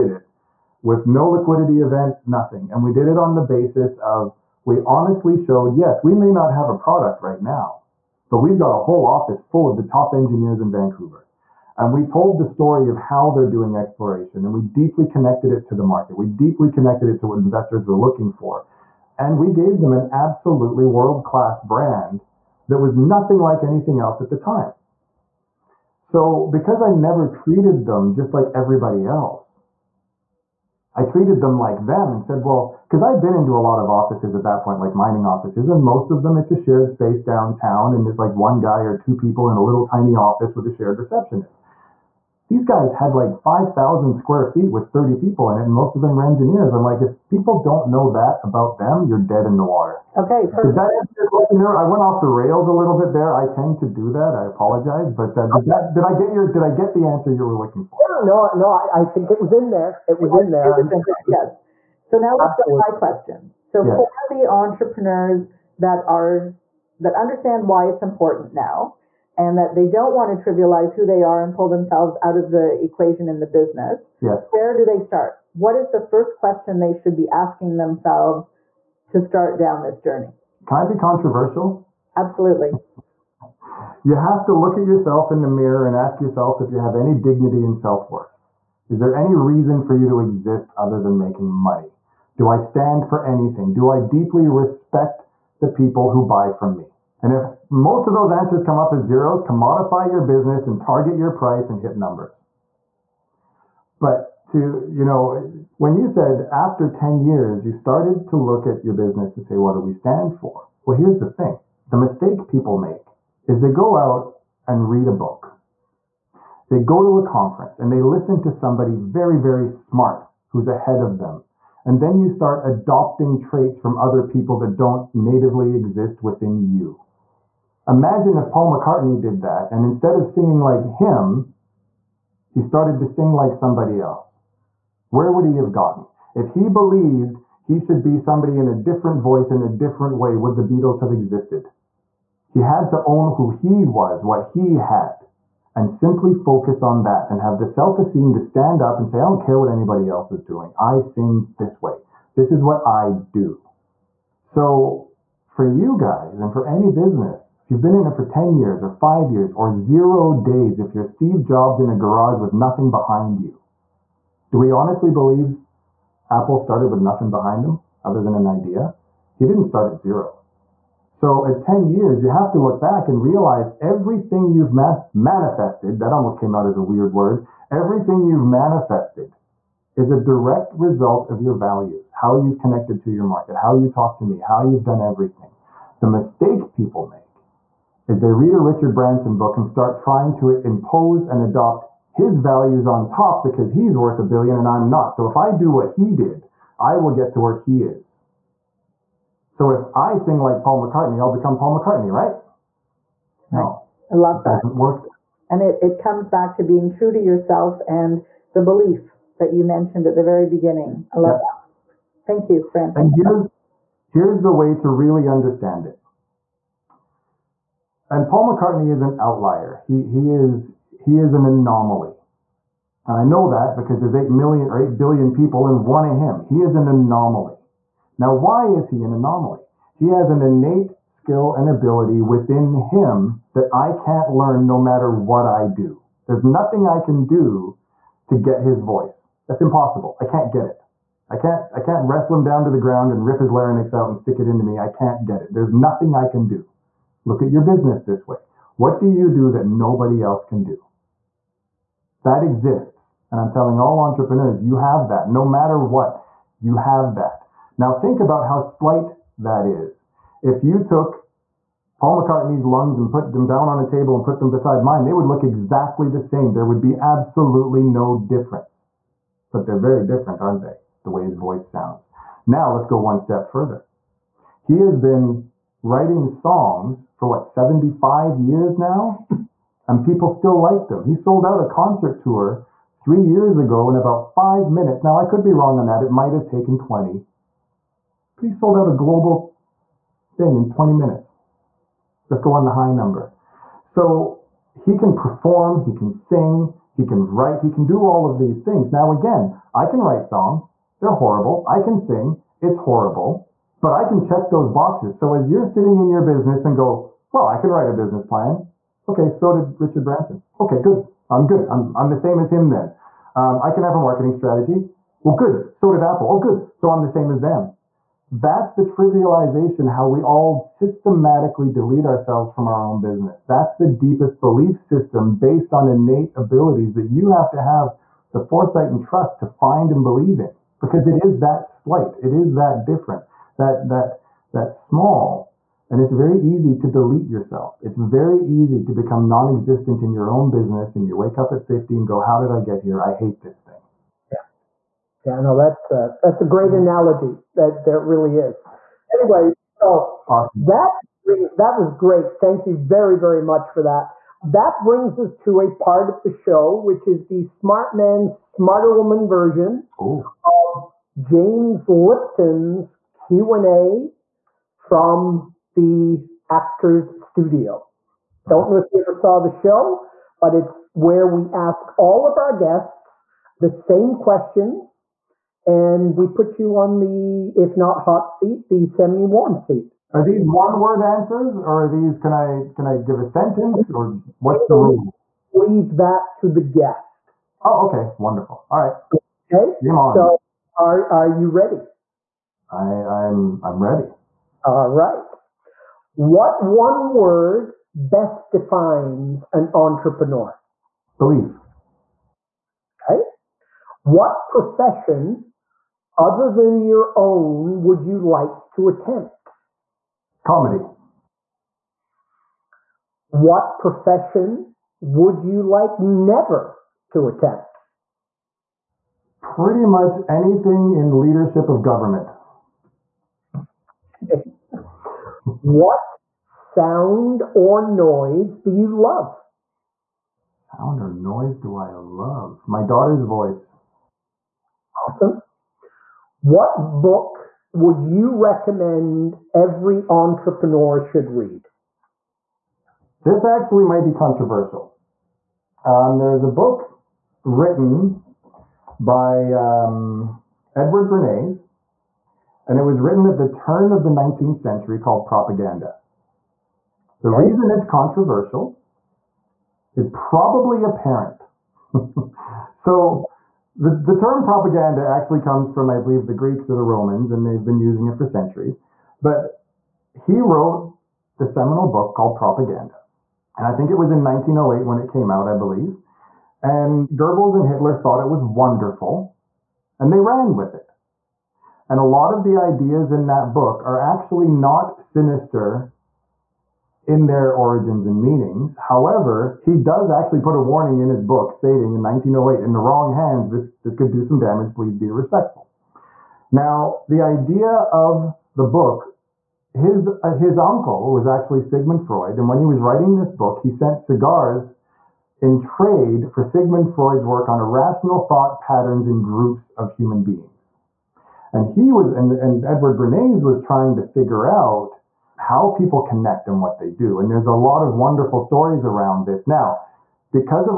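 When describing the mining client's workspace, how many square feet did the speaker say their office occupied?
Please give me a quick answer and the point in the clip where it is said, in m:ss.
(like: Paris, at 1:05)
5,000, at 0:43.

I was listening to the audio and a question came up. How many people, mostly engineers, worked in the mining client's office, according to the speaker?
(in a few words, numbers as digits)
30.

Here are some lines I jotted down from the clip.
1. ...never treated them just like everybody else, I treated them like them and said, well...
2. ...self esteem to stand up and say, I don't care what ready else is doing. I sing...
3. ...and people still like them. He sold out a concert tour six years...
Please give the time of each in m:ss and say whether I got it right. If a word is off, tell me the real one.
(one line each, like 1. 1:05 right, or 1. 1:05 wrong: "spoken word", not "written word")
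1. 0:26 right
2. 2:27 wrong: "anybody", not "ready"
3. 4:39 wrong: "three", not "six".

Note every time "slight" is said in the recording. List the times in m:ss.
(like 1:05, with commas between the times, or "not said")
4:18, 5:31.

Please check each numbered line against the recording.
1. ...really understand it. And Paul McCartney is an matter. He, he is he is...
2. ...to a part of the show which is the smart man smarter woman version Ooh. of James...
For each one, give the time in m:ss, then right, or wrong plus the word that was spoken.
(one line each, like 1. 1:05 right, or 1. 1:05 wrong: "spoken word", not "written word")
1. 3:34 wrong: "outlier", not "matter"
2. 5:55 right.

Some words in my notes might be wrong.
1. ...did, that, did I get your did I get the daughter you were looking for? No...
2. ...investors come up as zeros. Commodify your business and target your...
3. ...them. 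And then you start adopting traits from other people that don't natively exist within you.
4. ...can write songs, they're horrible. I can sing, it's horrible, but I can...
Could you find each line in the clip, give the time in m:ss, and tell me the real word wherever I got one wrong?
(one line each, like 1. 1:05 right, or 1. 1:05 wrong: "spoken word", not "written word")
1. 0:55 wrong: "answer", not "daughter"
2. 1:38 wrong: "answers", not "investors"
3. 2:01 right
4. 4:59 right.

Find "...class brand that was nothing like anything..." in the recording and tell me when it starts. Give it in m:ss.
0:21.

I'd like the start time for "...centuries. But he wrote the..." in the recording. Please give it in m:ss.
7:48.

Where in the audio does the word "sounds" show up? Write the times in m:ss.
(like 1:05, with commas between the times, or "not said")
4:31, 7:06, 7:10.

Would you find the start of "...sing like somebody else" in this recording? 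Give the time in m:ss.
2:13.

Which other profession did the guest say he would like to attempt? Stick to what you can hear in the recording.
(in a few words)
Comedy.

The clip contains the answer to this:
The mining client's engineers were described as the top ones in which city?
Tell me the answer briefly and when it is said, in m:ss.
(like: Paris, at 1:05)
Vancouver, at 0:10.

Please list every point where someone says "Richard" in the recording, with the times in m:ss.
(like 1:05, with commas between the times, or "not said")
3:08, 5:09.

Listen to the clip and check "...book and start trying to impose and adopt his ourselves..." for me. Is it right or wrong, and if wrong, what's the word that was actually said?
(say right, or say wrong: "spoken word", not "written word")
wrong: "values", not "ourselves".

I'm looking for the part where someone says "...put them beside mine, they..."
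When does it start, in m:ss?
4:24.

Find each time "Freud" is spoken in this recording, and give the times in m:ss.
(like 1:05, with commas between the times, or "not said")
8:22, 8:26.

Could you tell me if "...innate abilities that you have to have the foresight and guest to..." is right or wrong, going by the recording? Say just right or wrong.
wrong.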